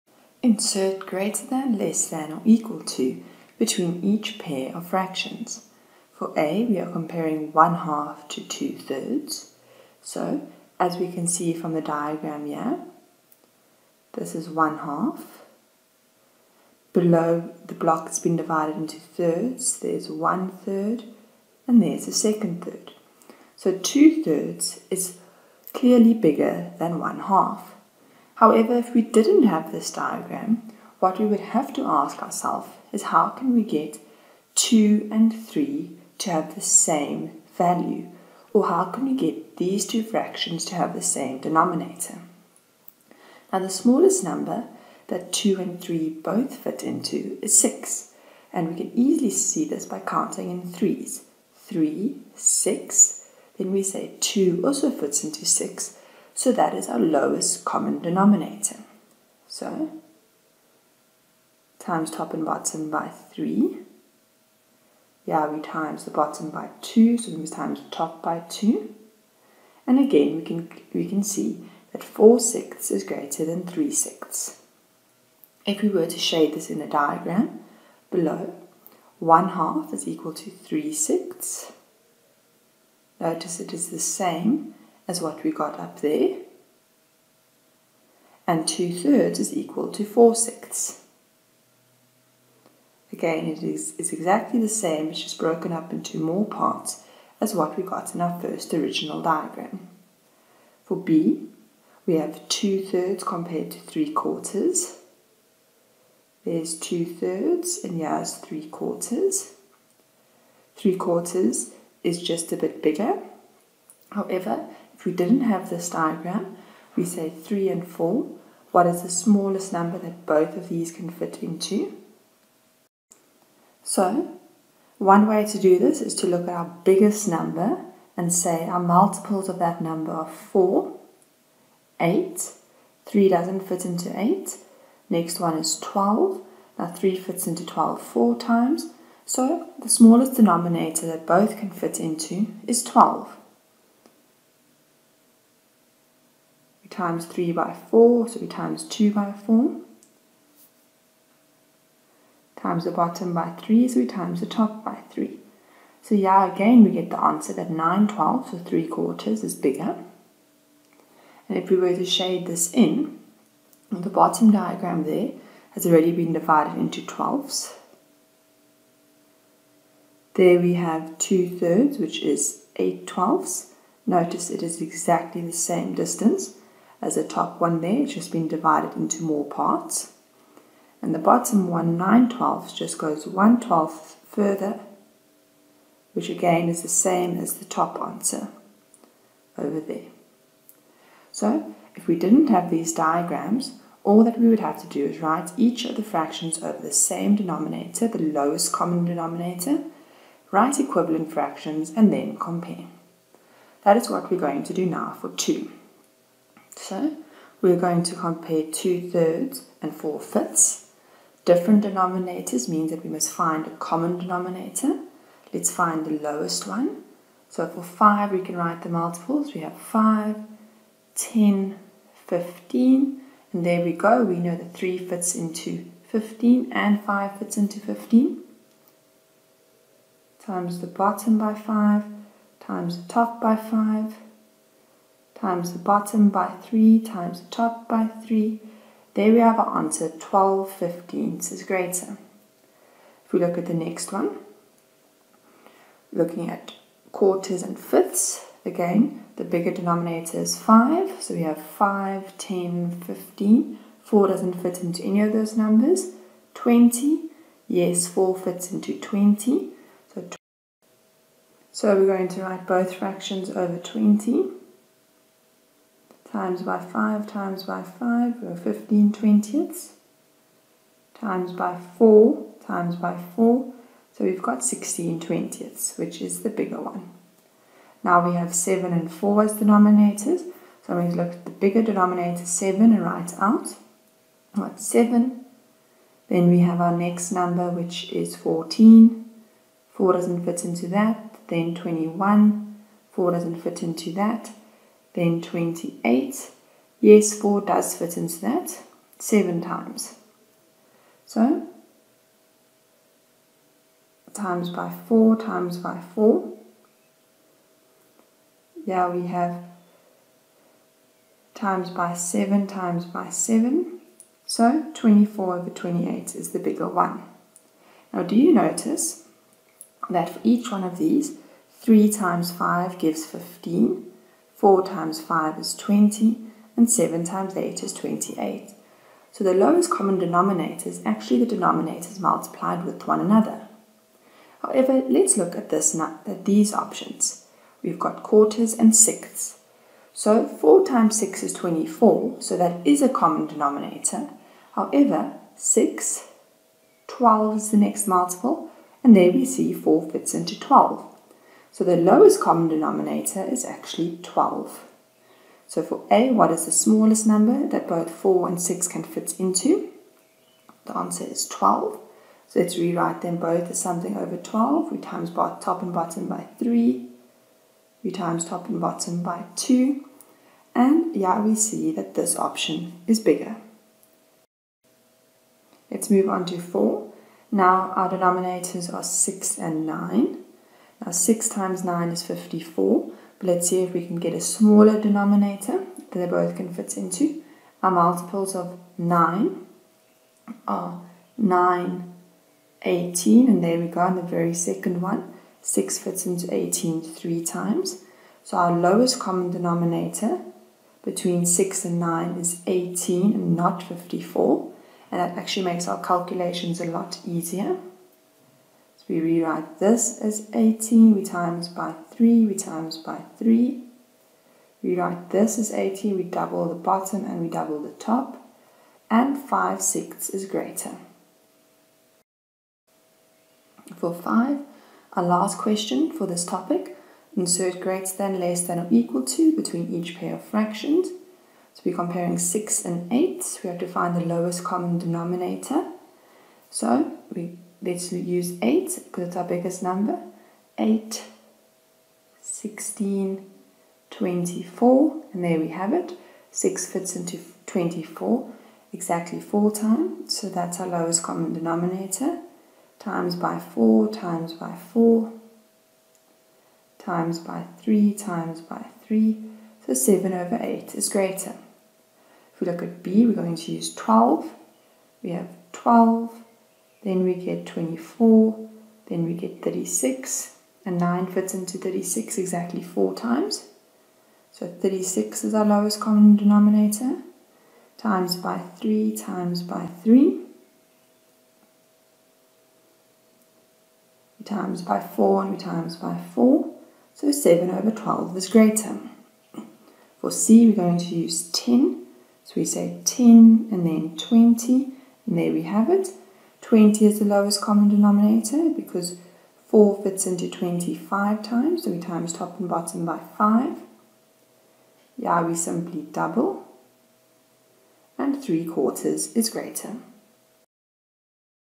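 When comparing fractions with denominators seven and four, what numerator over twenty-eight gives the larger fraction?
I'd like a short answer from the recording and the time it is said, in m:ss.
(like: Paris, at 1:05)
24, at 5:14.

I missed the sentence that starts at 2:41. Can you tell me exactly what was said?
And if we were to shade this in, the bottom diagram there has already been divided into twelfths.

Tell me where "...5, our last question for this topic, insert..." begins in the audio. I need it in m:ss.
7:04.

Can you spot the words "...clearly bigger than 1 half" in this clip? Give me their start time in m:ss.
0:25.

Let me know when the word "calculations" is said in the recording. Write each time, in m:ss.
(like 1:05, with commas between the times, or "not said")
6:46.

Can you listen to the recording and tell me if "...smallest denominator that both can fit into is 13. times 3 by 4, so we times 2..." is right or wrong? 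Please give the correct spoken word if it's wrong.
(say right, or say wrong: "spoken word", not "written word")
wrong: "12", not "13".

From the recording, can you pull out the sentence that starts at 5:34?
However, let's look at this at these options.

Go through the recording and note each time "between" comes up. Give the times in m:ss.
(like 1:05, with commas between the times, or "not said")
0:03, 6:41, 7:09.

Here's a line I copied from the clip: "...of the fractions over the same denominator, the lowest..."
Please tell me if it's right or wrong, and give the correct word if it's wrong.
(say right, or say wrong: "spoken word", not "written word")
right.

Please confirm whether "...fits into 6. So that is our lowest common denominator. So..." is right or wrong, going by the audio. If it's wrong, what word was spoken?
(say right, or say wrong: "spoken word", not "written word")
right.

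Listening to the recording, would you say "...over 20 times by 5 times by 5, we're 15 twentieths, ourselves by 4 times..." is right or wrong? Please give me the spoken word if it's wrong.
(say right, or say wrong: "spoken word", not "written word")
wrong: "times", not "ourselves".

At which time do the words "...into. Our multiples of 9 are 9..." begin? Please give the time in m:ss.
6:26.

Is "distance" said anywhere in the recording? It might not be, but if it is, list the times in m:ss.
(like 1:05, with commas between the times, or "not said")
2:55.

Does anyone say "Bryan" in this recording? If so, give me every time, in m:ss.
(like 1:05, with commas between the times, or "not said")
not said.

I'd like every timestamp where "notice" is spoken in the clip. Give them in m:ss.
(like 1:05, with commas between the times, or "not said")
1:23, 2:54, 5:18.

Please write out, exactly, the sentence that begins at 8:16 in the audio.
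20 is the lowest common denominator because 4 fits into 25 times, so we times top and bottom by 5.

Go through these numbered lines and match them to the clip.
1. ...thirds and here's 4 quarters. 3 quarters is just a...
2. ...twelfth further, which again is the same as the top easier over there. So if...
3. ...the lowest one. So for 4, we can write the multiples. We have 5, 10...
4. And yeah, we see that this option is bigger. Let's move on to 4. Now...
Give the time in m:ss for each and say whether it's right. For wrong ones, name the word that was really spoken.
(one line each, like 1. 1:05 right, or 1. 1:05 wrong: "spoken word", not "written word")
1. 1:47 wrong: "3", not "4"
2. 3:03 wrong: "answer", not "easier"
3. 3:36 wrong: "5", not "4"
4. 6:10 right.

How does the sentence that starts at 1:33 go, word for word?
Again, it is, exactly the same, it's just broken up into more parts as what we got in our first original diagram.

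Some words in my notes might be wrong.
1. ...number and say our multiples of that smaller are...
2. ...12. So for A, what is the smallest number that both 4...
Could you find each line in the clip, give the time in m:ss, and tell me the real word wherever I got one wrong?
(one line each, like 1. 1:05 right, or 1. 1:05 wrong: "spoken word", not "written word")
1. 2:07 wrong: "number", not "smaller"
2. 5:54 right.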